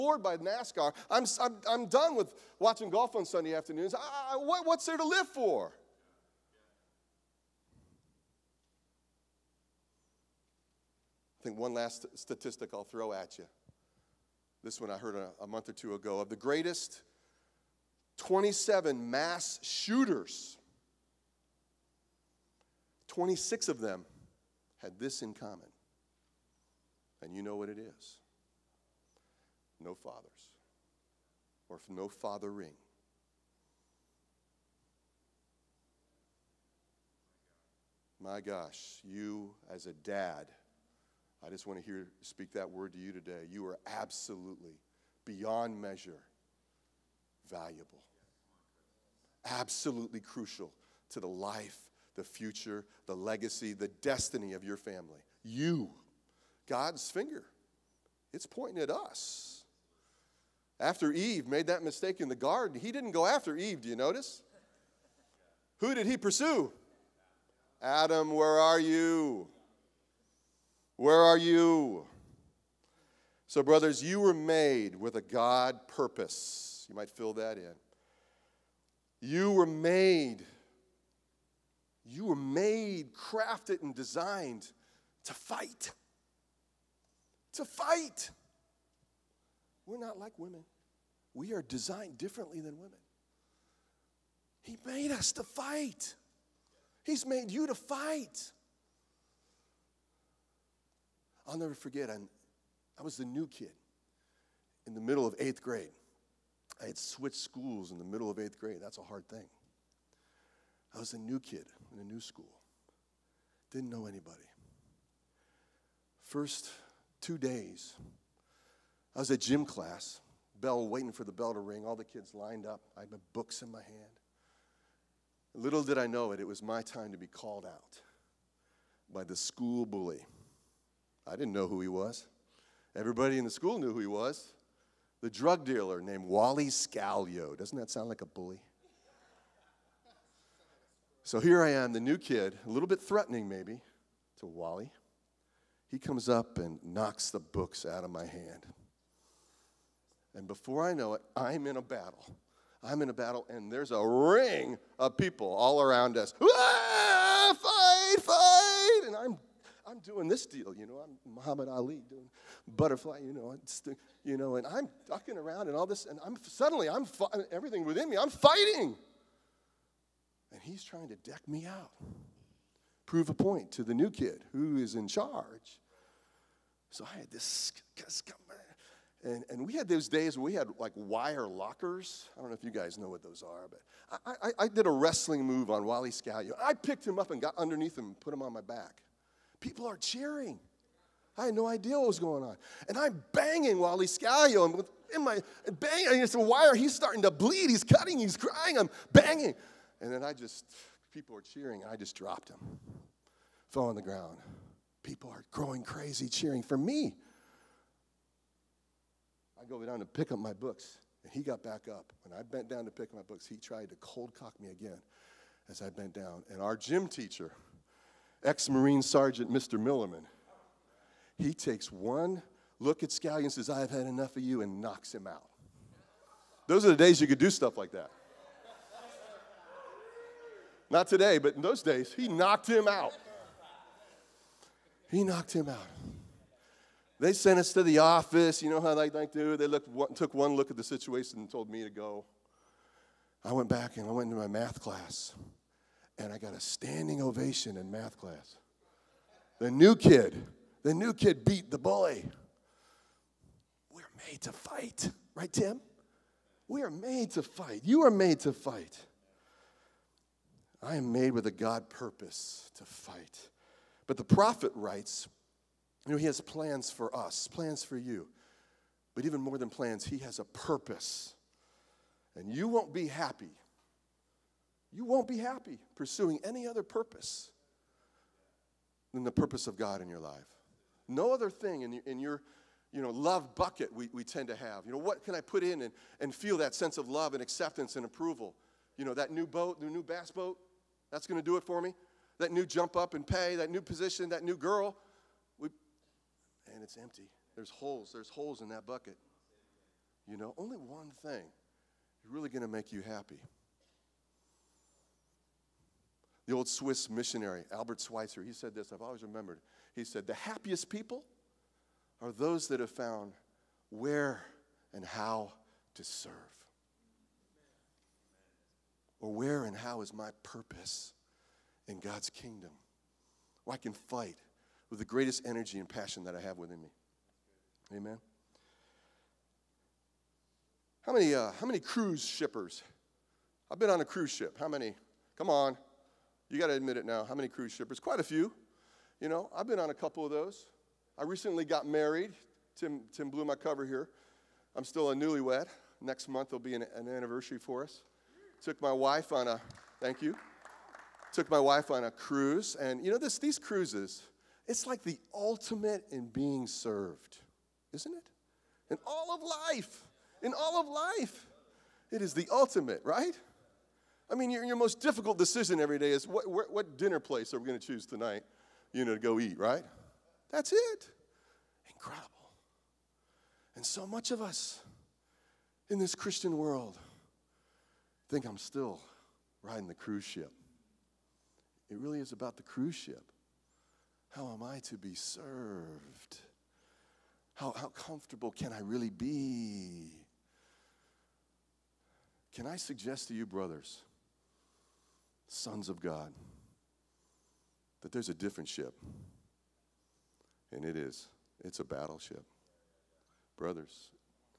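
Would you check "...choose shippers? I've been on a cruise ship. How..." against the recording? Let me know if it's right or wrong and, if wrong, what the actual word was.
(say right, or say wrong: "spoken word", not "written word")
wrong: "cruise", not "choose".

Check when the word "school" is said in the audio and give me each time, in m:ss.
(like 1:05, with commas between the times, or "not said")
1:47, 1:52, 2:09, 2:13.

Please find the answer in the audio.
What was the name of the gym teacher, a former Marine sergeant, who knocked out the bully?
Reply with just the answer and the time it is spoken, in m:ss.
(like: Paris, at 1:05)
Mr. Millerman, at 3:39.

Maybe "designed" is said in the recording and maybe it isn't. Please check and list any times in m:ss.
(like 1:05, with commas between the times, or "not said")
1:23, 1:31.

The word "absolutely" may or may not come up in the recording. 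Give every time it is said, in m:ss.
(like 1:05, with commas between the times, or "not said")
0:43, 0:49.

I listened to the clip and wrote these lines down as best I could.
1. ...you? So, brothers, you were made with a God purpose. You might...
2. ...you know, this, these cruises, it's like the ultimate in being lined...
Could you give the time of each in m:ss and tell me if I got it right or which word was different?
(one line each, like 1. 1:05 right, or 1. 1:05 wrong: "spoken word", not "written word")
1. 1:11 right
2. 5:53 wrong: "served", not "lined".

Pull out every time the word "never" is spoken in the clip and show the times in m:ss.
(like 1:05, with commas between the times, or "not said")
1:41.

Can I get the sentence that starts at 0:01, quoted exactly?
I'm, I'm, I'm done with watching golf on Sunday afternoons.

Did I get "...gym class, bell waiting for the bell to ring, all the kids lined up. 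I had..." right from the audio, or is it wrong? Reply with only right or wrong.
right.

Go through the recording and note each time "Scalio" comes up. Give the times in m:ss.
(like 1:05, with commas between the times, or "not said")
2:16, 3:06, 3:14, 3:43.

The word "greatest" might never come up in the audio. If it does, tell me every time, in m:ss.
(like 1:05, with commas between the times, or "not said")
0:16, 5:25.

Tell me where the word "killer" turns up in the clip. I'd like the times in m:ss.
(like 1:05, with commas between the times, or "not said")
not said.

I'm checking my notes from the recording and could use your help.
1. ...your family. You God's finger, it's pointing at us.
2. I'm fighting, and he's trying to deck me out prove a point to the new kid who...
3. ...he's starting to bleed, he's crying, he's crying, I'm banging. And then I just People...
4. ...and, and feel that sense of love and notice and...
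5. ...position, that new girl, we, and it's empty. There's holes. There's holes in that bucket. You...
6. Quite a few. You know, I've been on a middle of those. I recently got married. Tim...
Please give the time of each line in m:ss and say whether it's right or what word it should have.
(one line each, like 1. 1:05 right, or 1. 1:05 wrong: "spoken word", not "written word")
1. 0:54 right
2. 2:48 right
3. 3:16 wrong: "cutting", not "crying"
4. 4:45 wrong: "acceptance", not "notice"
5. 4:53 right
6. 5:37 wrong: "couple", not "middle".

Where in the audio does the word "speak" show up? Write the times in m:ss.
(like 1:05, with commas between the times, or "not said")
0:42.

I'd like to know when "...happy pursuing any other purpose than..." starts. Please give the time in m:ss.
4:35.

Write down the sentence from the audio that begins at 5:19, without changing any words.
Or where and how is my purpose in God's kingdom?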